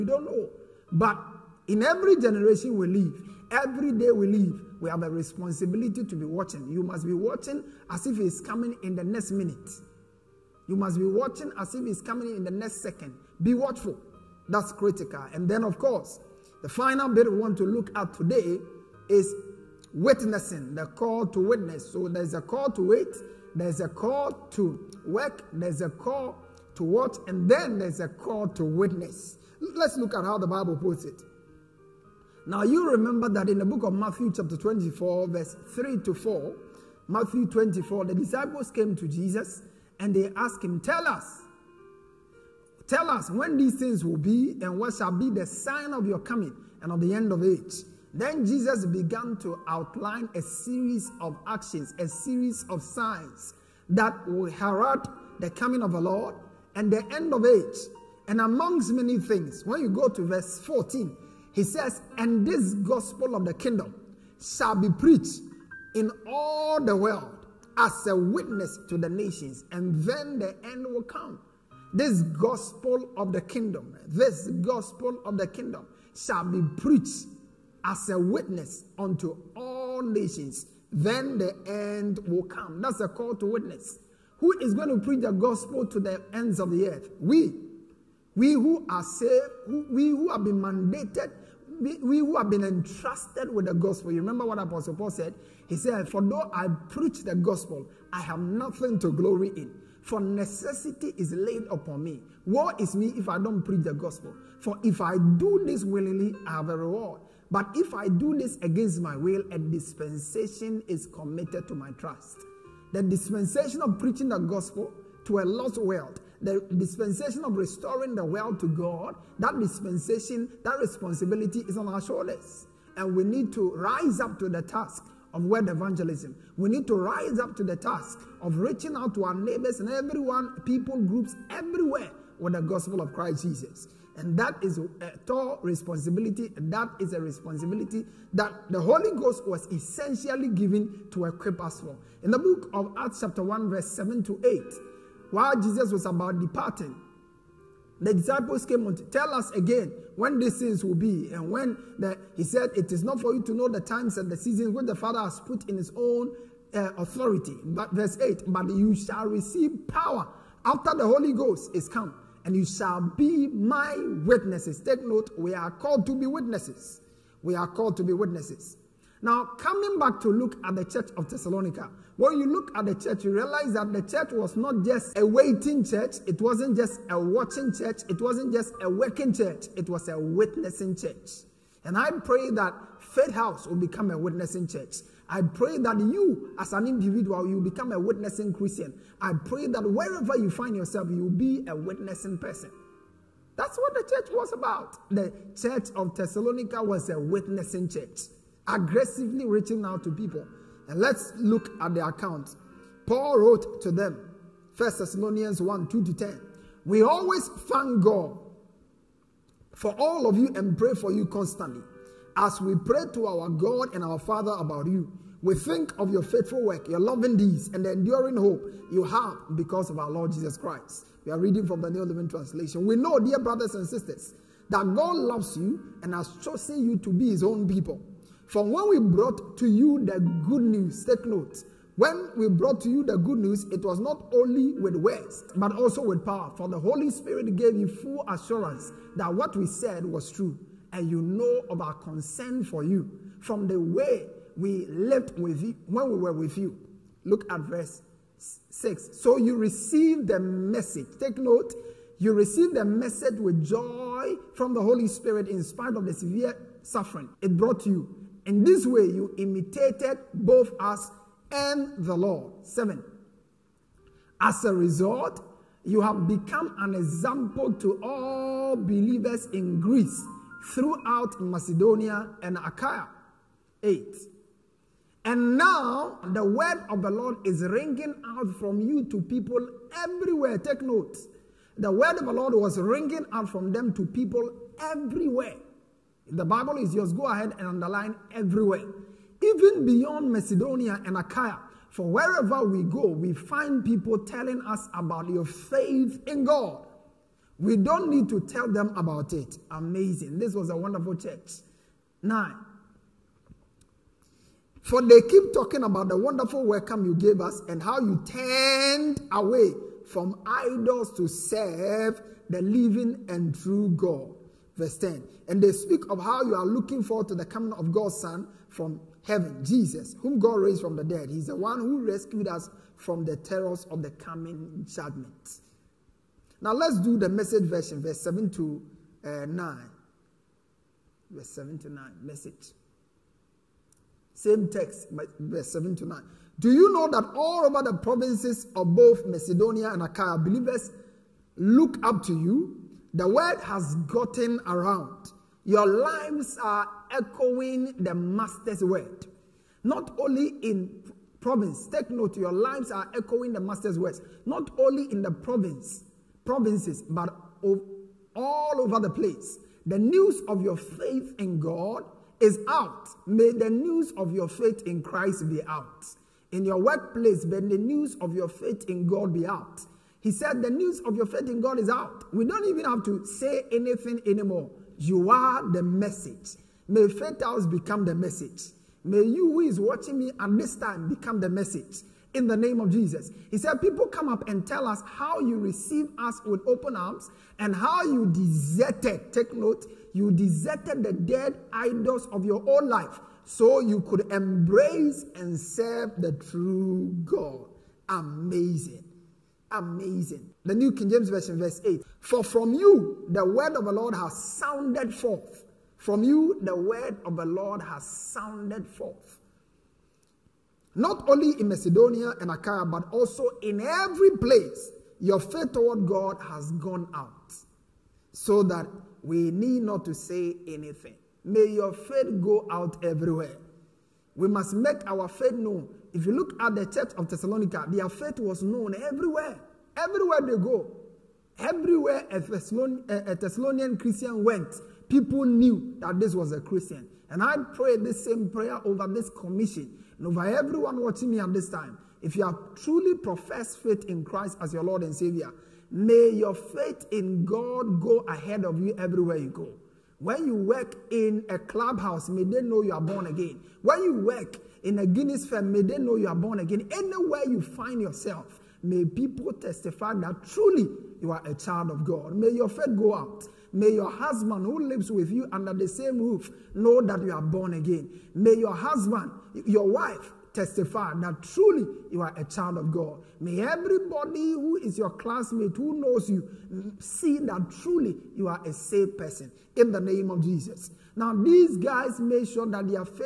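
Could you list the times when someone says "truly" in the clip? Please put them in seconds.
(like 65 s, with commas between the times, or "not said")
442 s, 460 s, 471 s, 477 s.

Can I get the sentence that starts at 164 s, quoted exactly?
Take note: we are called to be witnesses.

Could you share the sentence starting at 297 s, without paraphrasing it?
We don't need to tell them about it.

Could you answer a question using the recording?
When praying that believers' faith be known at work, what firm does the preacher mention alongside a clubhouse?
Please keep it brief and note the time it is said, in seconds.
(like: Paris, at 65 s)
Guinness firm, at 455 s.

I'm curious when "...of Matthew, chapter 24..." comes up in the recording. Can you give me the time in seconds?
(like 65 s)
33 s.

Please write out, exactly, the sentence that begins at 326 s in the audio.
Now let's do the message version, verse 7 to uh, 9.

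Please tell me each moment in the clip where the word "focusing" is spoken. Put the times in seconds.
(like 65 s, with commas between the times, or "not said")
not said.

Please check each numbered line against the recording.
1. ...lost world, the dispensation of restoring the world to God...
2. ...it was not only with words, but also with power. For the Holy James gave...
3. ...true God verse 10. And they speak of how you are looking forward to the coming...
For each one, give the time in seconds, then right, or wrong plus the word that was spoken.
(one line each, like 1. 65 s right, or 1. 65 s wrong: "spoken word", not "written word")
1. 115 s right
2. 233 s wrong: "Spirit", not "James"
3. 313 s right.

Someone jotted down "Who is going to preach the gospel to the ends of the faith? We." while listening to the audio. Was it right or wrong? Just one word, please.
wrong.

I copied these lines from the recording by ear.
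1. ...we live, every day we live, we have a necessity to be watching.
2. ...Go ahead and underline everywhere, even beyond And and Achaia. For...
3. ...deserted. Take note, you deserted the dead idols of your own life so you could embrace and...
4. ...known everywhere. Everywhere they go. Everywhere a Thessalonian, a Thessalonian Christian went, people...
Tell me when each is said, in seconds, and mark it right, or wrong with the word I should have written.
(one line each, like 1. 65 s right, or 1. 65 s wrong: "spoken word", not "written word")
1. 2 s wrong: "responsibility", not "necessity"
2. 287 s wrong: "Macedonia", not "And"
3. 388 s right
4. 428 s right.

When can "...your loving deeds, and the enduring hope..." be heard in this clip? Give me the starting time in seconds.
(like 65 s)
216 s.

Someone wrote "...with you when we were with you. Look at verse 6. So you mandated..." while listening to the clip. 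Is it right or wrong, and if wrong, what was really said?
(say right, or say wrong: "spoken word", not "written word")
wrong: "received", not "mandated".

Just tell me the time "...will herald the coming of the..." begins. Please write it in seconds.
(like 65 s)
54 s.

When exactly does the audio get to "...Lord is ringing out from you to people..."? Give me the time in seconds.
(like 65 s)
277 s.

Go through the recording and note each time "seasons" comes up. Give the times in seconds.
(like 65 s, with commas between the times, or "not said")
154 s.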